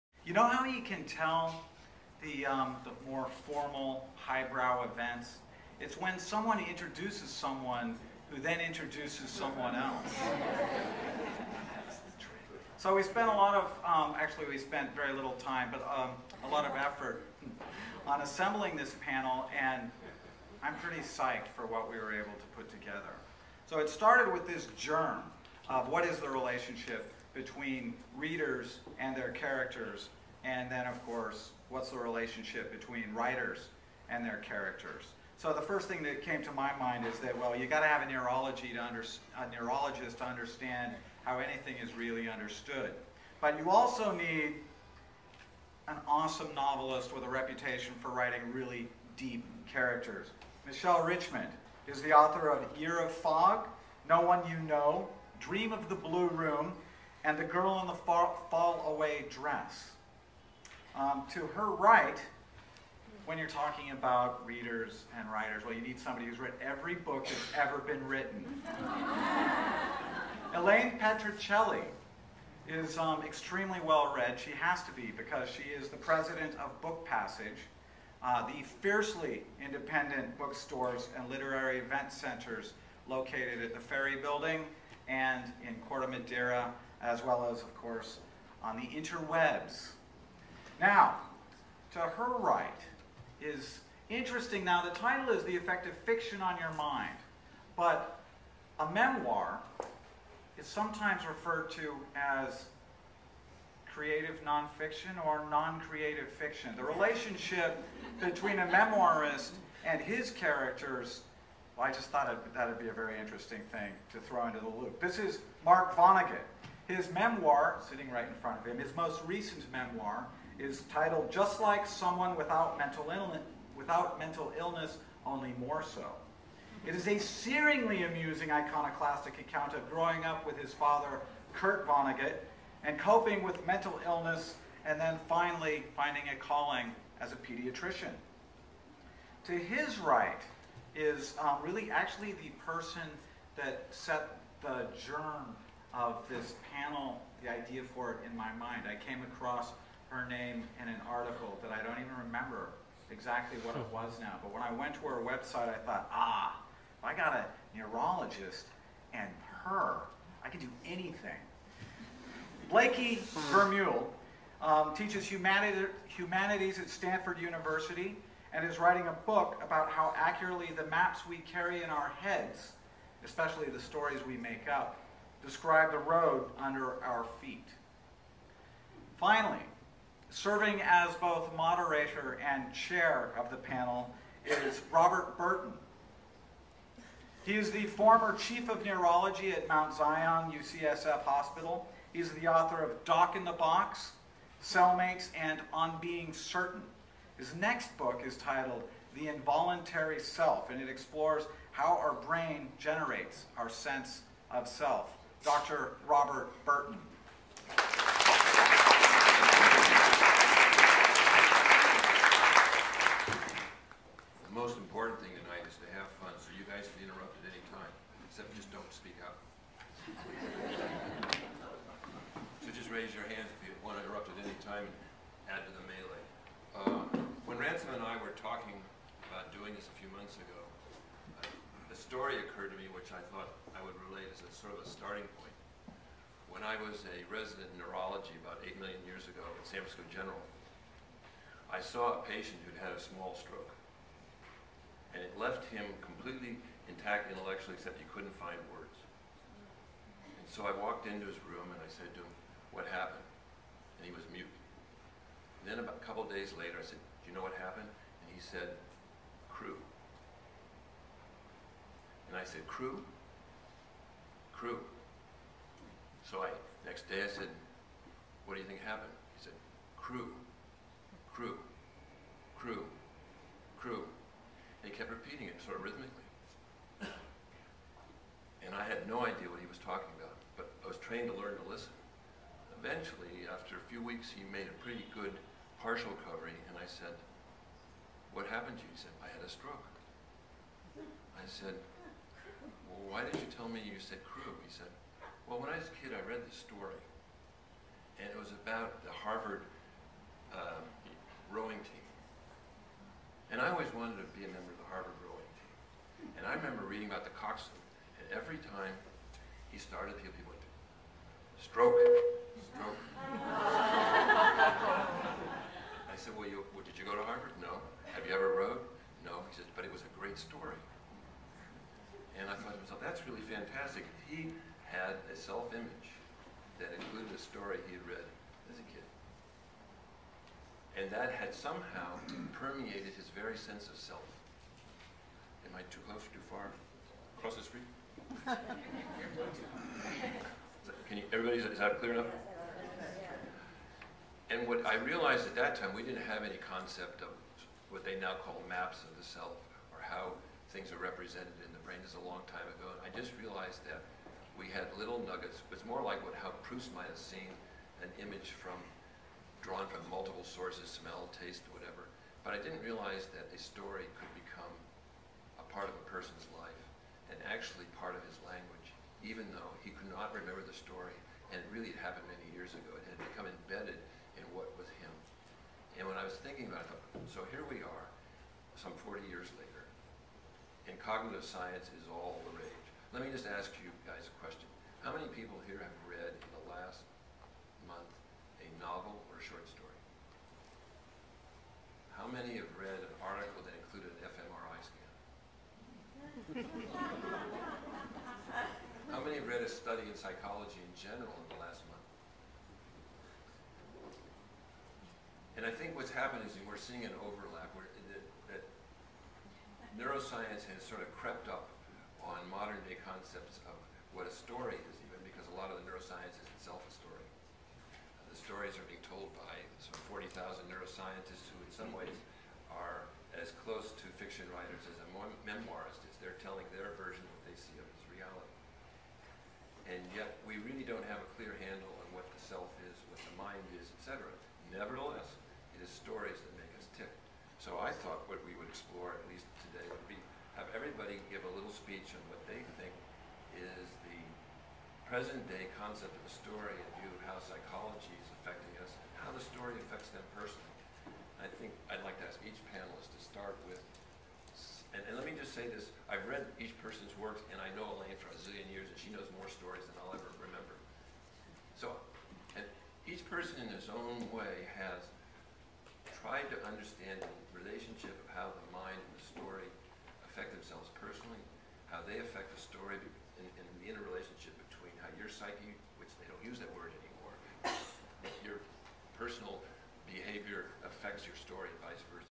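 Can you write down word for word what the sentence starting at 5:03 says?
And I always wanted to be a member of the Harvard rowing team.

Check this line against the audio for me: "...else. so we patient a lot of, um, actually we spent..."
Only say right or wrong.
wrong.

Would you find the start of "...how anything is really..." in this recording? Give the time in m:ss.
0:41.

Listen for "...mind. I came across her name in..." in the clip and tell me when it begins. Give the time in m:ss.
2:28.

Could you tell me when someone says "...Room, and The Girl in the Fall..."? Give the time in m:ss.
0:56.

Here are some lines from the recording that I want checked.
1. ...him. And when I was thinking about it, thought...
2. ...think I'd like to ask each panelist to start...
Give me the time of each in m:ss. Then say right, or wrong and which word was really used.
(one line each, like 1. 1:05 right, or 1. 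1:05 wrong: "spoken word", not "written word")
1. 6:14 right
2. 7:31 right.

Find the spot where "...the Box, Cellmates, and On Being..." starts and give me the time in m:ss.
3:13.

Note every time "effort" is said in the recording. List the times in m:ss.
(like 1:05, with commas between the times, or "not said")
0:16.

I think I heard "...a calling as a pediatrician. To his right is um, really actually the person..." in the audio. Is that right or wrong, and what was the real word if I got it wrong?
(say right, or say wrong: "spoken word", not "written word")
right.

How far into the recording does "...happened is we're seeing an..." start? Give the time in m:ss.
6:46.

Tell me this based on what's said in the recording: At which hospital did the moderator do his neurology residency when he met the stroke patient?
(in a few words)
San Francisco General.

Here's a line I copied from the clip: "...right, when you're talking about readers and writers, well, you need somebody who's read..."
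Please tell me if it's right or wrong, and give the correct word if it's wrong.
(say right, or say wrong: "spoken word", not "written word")
right.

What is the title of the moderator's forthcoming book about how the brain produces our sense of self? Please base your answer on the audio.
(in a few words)
The Involuntary Self.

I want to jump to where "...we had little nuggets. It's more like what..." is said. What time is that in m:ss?
5:54.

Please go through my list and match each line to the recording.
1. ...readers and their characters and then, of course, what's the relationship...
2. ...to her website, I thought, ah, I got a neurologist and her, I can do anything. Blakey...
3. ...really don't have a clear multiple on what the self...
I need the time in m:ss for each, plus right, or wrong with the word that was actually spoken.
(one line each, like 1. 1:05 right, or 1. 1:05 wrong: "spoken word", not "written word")
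1. 0:28 right
2. 2:34 right
3. 7:10 wrong: "handle", not "multiple".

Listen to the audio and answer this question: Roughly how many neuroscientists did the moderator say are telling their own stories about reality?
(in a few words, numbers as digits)
40,000.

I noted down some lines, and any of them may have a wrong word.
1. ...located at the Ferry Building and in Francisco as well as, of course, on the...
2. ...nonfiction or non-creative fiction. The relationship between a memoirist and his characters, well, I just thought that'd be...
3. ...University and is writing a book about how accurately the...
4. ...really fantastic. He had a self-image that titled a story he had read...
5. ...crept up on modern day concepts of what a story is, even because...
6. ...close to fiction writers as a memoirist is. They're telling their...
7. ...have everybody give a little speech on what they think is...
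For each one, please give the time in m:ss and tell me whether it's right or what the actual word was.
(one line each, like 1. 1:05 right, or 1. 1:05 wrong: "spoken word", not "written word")
1. 1:23 wrong: "Corte", not "Francisco"
2. 1:44 right
3. 2:47 right
4. 5:23 wrong: "included", not "titled"
5. 6:51 right
6. 7:03 right
7. 7:20 right.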